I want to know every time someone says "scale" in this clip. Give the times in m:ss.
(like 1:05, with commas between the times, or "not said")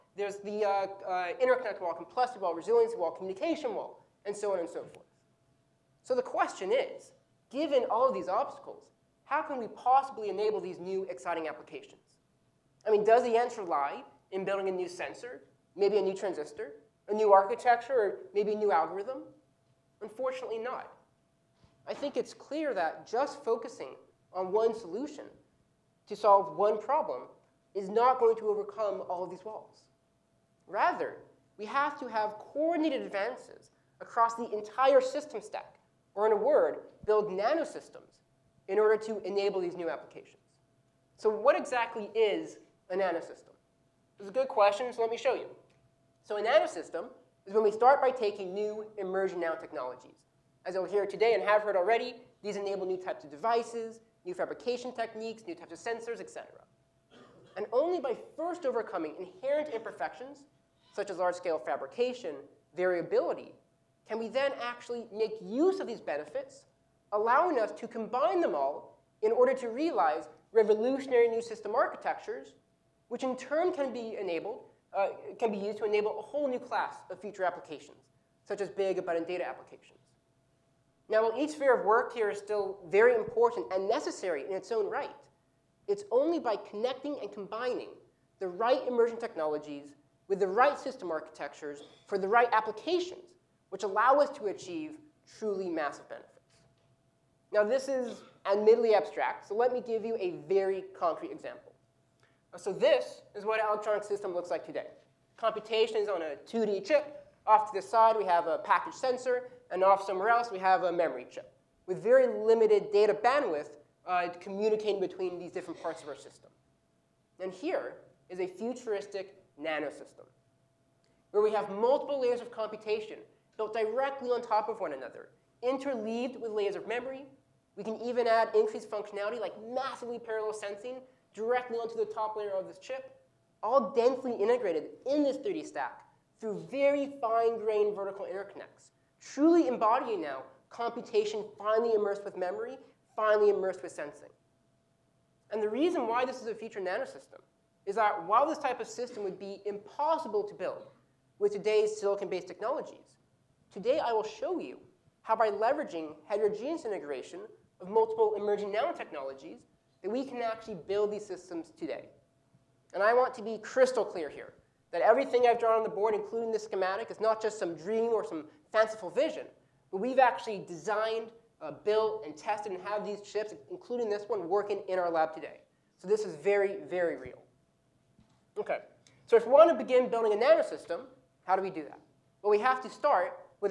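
1:01.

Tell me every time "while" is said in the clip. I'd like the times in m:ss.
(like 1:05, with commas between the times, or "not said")
1:21, 2:28.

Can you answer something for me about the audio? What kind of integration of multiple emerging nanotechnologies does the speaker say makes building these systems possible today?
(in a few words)
heterogeneous integration.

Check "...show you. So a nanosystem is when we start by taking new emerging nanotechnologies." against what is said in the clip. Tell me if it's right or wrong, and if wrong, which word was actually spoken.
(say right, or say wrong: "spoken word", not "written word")
right.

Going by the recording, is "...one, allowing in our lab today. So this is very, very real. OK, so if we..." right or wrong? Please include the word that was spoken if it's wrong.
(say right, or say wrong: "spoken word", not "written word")
wrong: "working", not "allowing".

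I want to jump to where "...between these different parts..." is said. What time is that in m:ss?
1:54.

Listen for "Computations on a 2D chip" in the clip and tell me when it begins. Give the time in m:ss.
1:45.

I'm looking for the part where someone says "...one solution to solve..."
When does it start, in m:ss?
0:24.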